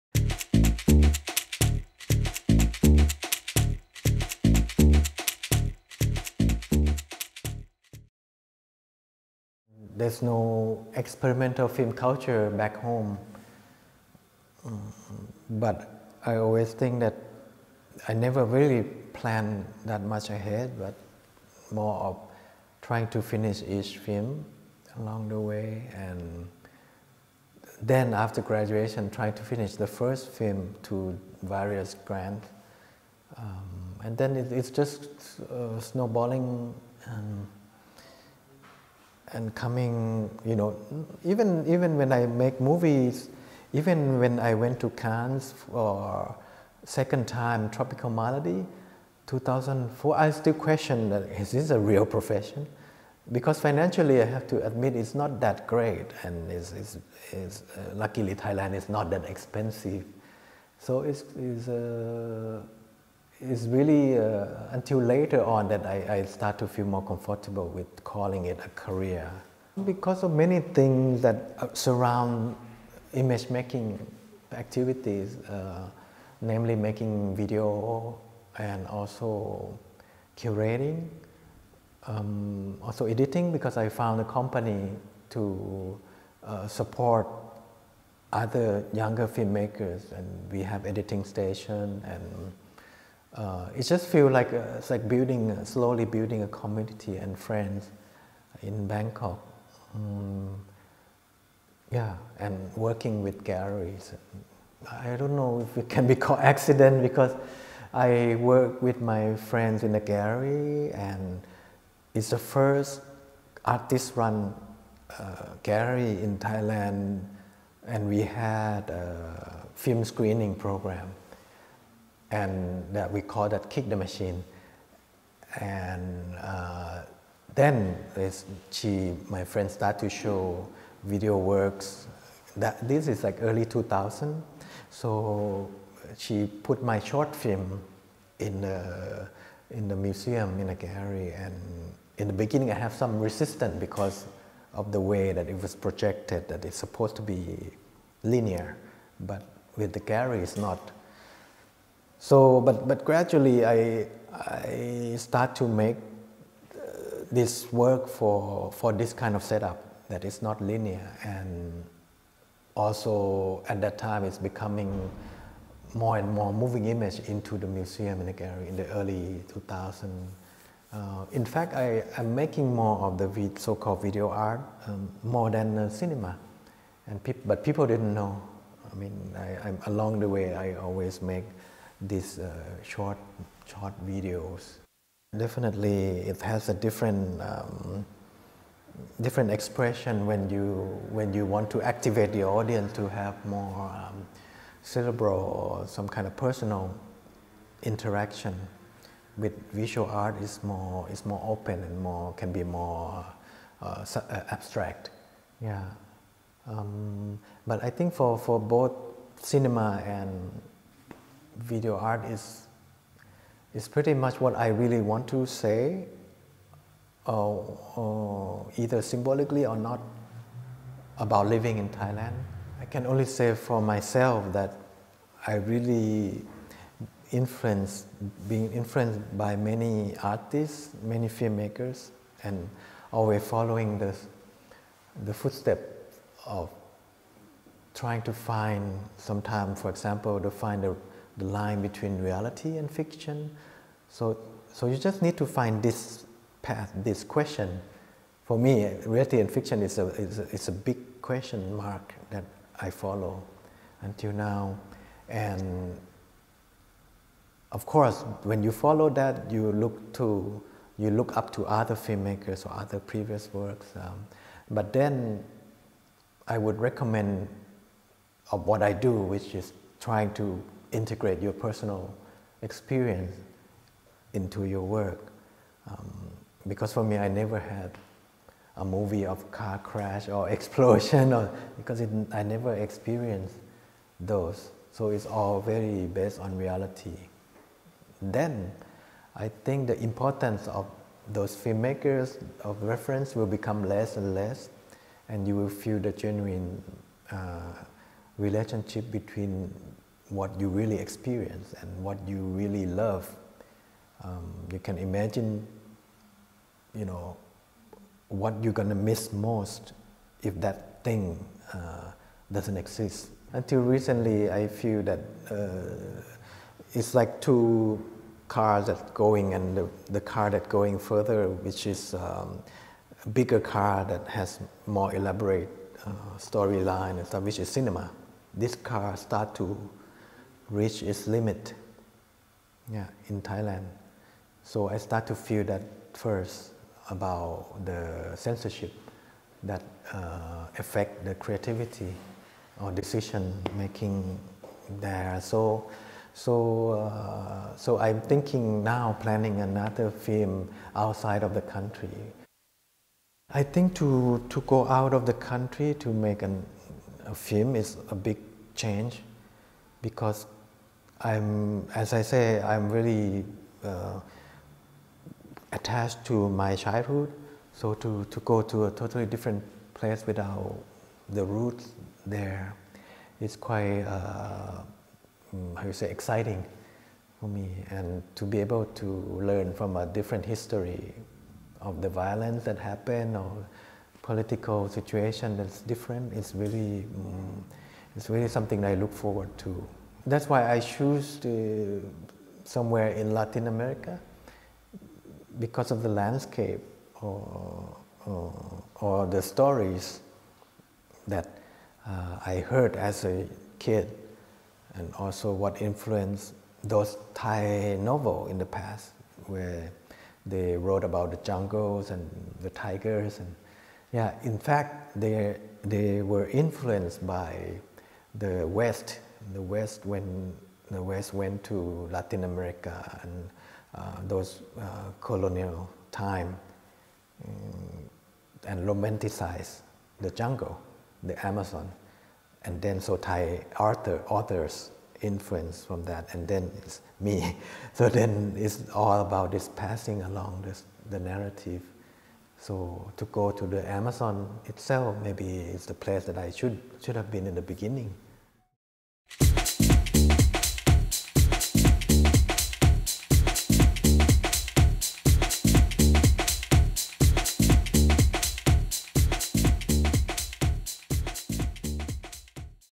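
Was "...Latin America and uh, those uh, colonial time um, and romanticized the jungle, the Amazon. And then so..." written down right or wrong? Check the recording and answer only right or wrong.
right.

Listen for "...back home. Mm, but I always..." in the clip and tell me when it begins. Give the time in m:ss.
0:12.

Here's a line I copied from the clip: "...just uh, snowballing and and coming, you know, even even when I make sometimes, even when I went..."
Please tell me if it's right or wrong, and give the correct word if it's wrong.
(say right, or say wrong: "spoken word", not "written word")
wrong: "movies", not "sometimes".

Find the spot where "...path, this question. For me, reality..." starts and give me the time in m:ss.
4:06.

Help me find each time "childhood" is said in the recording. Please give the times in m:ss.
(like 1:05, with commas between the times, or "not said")
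6:06.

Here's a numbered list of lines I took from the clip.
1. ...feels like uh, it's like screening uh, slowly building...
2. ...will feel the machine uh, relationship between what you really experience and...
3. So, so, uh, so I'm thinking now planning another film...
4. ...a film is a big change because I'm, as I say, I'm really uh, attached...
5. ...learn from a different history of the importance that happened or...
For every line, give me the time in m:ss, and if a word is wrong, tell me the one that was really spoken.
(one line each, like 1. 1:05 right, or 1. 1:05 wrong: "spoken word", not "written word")
1. 1:34 wrong: "building", not "screening"
2. 4:55 wrong: "genuine", not "machine"
3. 5:45 right
4. 5:57 right
5. 6:19 wrong: "violence", not "importance".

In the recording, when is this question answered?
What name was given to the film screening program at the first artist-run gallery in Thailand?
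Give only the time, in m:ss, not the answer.
2:03.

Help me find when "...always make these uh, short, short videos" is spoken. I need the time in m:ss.
3:00.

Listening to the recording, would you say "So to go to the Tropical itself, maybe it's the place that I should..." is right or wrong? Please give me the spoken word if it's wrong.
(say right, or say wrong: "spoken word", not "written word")
wrong: "Amazon", not "Tropical".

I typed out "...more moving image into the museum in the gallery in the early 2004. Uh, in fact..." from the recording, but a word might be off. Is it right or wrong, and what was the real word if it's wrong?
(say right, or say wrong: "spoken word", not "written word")
wrong: "2000", not "2004".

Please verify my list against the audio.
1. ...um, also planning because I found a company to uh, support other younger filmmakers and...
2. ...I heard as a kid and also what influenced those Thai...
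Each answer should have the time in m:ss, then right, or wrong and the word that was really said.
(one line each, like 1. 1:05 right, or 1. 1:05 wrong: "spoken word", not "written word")
1. 1:22 wrong: "editing", not "planning"
2. 6:42 right.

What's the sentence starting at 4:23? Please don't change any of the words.
Um, but then, I would recommend of uh, what I do, which is trying to integrate your personal experience into your work.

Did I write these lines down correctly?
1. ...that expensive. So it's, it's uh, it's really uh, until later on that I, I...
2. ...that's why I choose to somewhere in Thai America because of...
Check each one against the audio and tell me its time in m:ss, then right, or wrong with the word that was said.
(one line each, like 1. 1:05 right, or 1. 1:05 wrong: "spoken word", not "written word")
1. 0:59 right
2. 6:30 wrong: "Latin", not "Thai".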